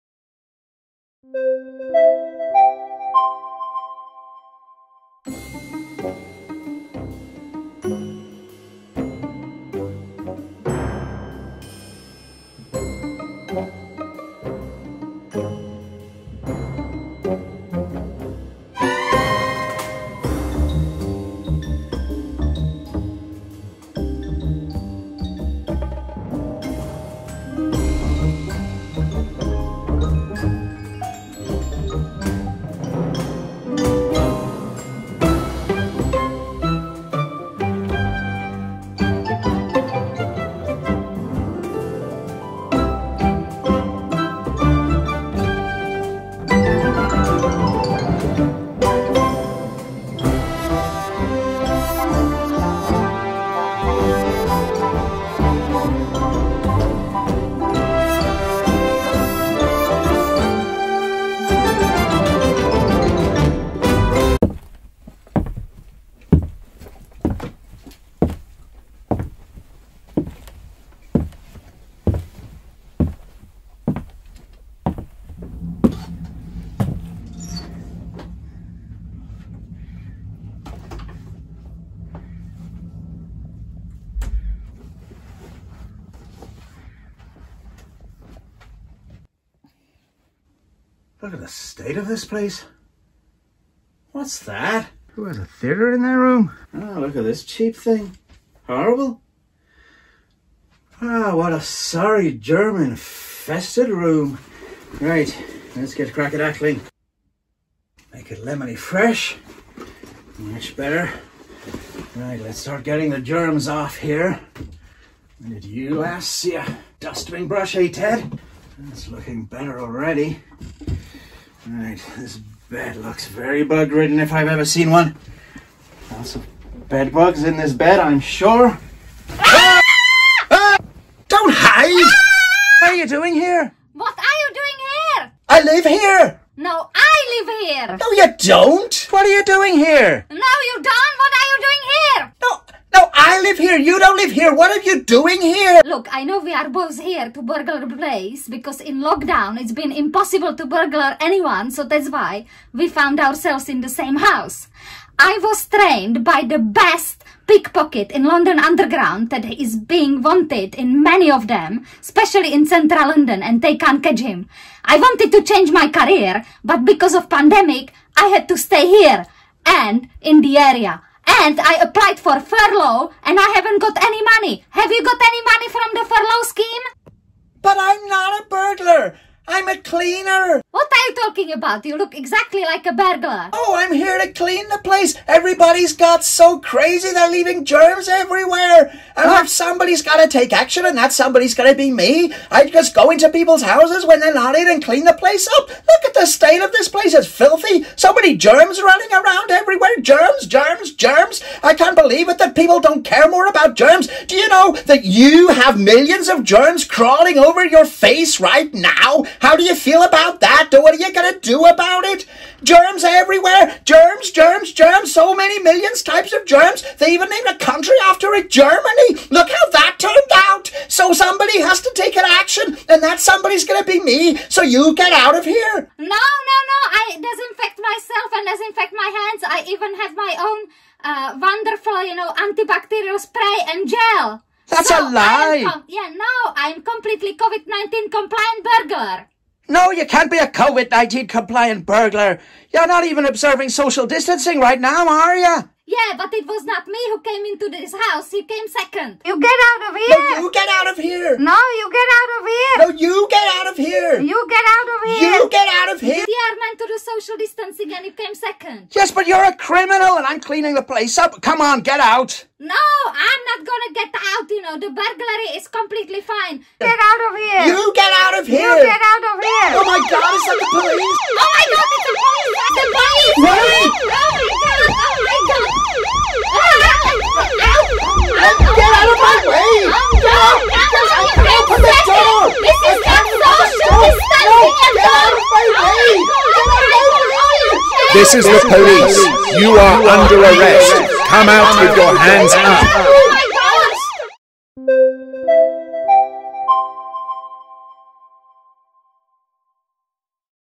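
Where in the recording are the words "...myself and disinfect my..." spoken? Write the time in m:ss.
3:47.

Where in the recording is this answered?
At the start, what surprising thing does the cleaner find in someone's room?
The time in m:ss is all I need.
1:35.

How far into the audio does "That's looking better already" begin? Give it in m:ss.
1:58.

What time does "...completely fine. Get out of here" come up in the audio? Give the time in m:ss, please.
4:25.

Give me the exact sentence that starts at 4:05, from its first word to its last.
Yeah, but it was not me who came into this house.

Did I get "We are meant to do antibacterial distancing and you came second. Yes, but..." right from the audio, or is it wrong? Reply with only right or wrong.
wrong.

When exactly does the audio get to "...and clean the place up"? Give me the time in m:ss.
3:14.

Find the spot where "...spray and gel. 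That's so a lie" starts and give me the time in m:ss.
3:53.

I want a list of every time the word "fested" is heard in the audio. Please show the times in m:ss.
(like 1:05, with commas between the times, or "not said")
1:42.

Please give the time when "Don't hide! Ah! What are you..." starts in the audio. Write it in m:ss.
2:11.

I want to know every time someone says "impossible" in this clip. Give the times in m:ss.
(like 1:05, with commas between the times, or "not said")
2:29.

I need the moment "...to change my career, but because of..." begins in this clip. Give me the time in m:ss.
2:45.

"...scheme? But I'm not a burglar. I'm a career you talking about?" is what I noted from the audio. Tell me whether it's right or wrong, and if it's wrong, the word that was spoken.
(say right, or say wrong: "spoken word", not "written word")
wrong: "cleaner", not "career".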